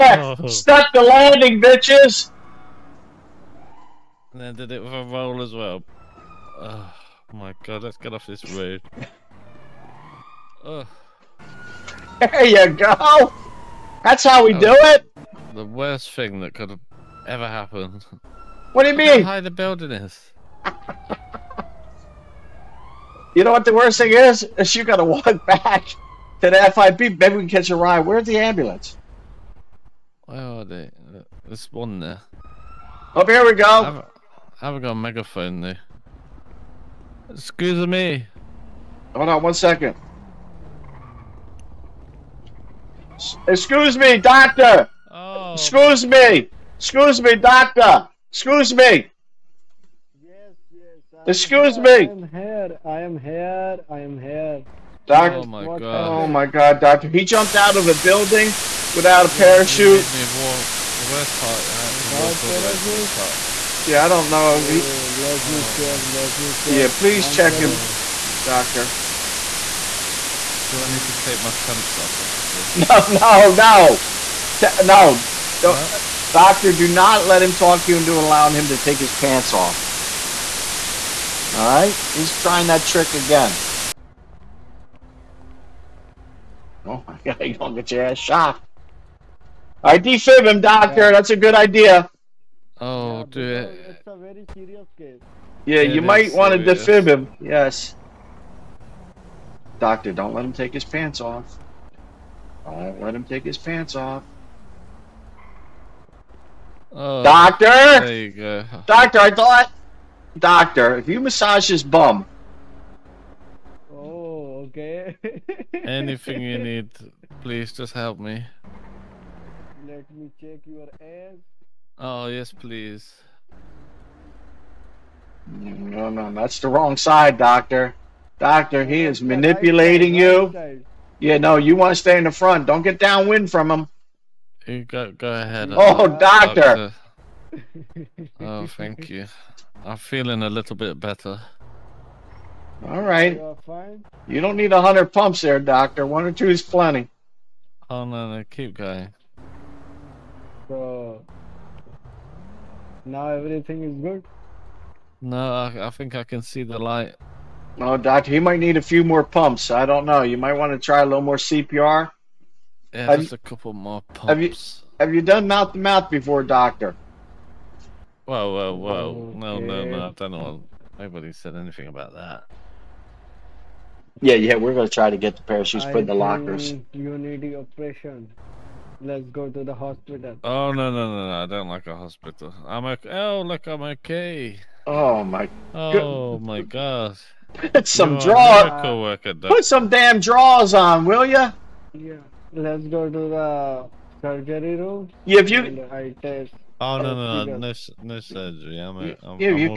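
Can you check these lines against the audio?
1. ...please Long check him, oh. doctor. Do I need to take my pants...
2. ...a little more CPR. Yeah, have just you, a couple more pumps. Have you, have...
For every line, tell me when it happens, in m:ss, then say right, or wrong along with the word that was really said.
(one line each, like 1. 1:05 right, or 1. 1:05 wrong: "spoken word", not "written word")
1. 1:06 right
2. 2:41 right.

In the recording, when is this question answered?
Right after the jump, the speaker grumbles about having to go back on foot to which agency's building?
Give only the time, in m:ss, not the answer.
0:26.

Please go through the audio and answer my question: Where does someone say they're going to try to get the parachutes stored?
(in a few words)
lockers.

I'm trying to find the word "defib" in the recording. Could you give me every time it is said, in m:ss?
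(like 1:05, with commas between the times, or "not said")
1:29, 1:36.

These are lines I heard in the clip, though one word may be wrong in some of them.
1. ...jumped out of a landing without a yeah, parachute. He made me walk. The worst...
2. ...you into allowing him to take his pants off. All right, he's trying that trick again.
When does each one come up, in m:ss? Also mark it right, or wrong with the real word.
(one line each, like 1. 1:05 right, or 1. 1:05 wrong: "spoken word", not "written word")
1. 0:57 wrong: "building", not "landing"
2. 1:17 right.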